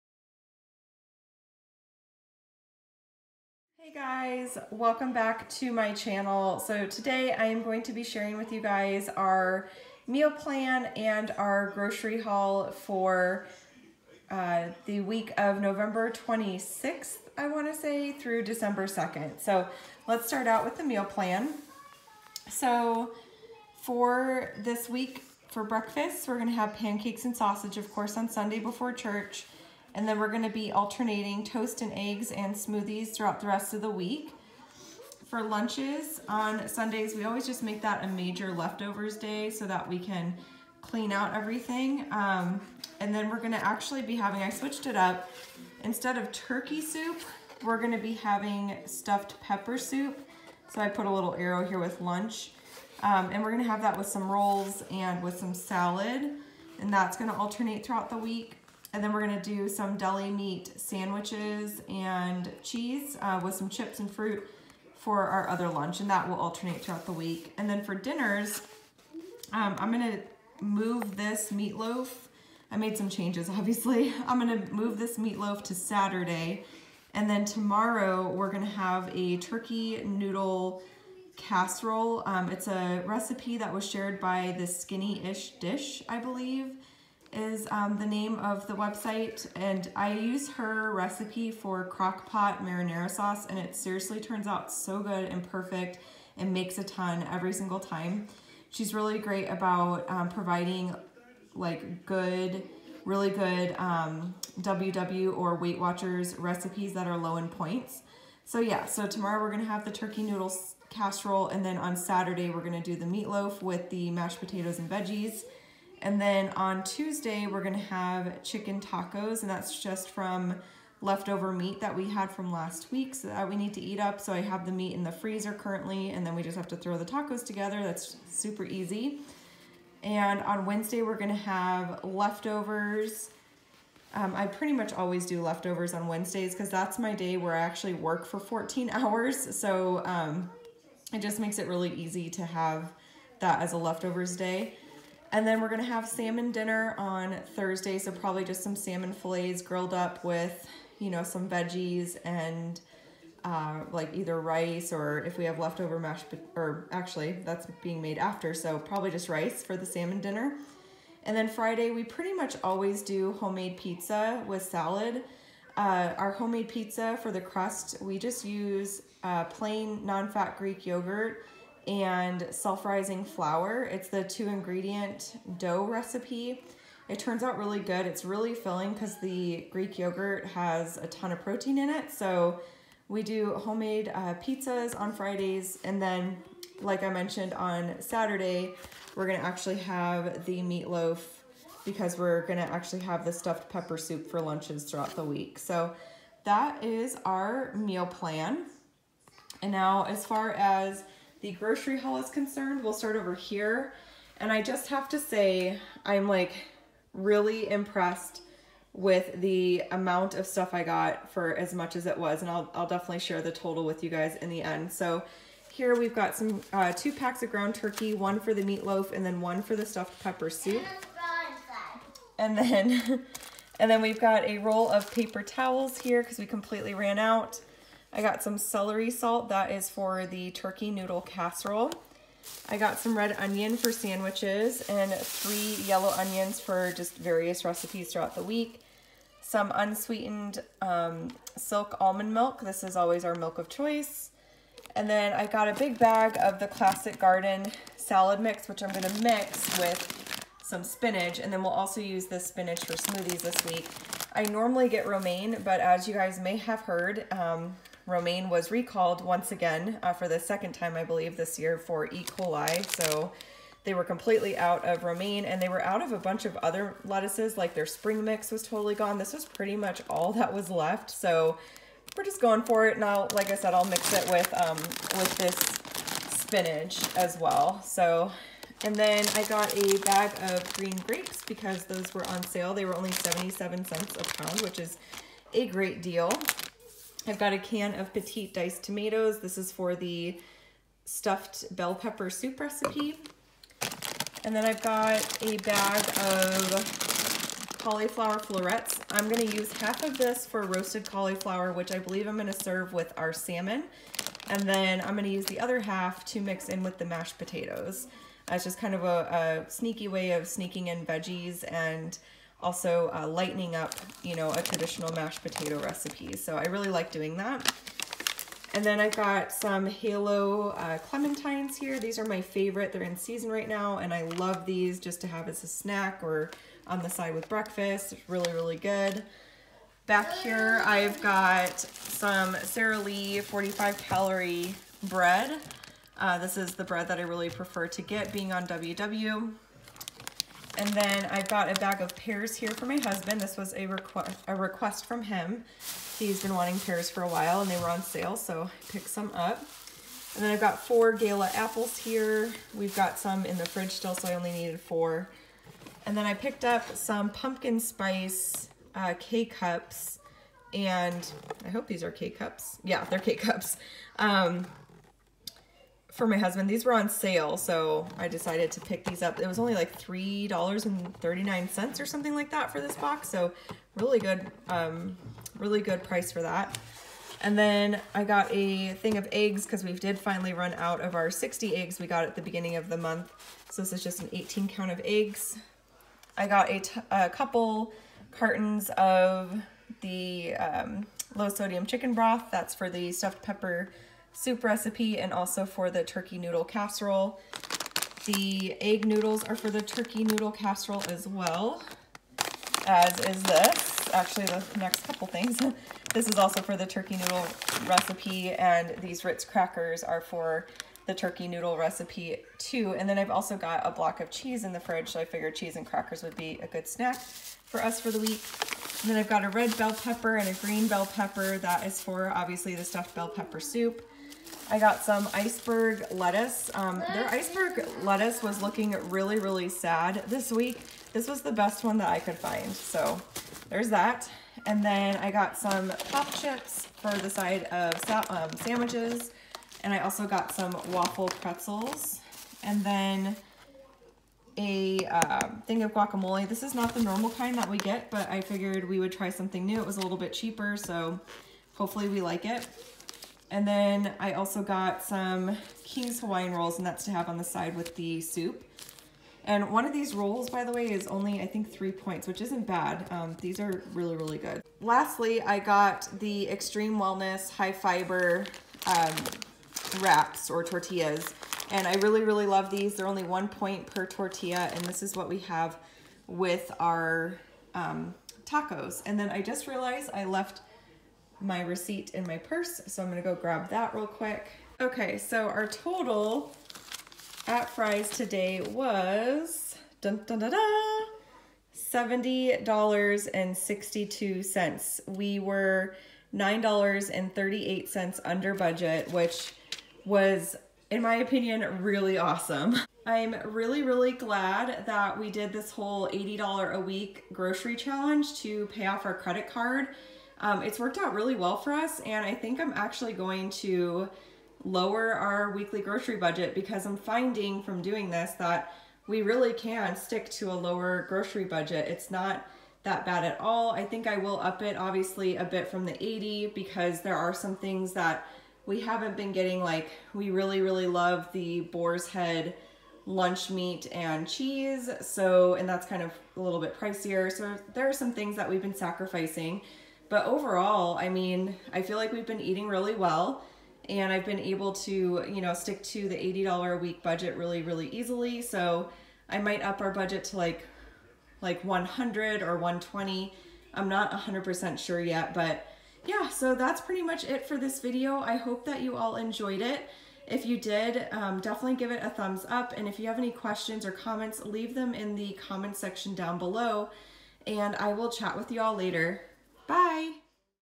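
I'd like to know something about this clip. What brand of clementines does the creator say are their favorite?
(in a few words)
Halo.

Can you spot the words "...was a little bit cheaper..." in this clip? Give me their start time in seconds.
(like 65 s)
449 s.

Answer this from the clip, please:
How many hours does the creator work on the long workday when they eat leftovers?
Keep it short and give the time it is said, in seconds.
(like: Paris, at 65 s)
14, at 138 s.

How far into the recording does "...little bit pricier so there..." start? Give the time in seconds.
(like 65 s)
536 s.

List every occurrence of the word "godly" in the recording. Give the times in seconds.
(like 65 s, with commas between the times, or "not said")
not said.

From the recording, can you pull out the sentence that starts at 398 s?
The egg noodles are for the turkey noodle casserole as well, as is this.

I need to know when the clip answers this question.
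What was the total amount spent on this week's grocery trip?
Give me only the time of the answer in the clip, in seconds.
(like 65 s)
491 s.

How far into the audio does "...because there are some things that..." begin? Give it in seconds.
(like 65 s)
526 s.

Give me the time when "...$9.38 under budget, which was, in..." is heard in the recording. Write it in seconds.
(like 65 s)
496 s.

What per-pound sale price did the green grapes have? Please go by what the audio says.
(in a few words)
77 cents.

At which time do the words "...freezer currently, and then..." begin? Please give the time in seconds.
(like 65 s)
125 s.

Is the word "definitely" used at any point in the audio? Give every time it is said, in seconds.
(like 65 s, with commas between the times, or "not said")
212 s, 561 s.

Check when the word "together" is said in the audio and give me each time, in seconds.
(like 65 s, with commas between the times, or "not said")
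127 s.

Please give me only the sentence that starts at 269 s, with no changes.
This was pretty much all that was left.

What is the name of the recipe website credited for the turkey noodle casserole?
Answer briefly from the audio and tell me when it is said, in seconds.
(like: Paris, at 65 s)
Skinny Ish Dish, at 84 s.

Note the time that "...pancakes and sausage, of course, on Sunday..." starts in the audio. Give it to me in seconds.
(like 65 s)
26 s.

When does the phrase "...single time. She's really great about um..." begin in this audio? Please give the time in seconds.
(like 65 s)
97 s.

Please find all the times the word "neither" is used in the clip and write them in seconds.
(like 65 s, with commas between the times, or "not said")
not said.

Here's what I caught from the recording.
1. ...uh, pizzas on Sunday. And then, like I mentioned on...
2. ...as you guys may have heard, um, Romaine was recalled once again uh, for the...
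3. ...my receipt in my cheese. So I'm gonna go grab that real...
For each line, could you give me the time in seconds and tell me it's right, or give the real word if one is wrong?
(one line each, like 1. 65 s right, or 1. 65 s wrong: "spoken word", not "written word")
1. 184 s wrong: "Fridays", not "Sunday"
2. 255 s right
3. 481 s wrong: "purse", not "cheese".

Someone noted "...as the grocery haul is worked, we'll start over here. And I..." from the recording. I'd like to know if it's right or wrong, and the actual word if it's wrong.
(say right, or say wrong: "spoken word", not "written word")
wrong: "concerned", not "worked".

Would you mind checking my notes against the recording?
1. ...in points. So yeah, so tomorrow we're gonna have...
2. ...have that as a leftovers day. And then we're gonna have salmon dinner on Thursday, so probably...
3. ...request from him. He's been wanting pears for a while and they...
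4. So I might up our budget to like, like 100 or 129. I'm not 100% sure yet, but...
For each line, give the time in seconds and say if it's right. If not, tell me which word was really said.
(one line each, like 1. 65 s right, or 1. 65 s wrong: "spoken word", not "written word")
1. 107 s right
2. 142 s right
3. 344 s right
4. 548 s wrong: "120", not "129".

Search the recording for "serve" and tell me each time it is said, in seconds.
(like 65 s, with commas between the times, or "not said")
302 s.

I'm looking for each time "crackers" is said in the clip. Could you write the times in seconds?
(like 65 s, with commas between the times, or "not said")
409 s, 415 s.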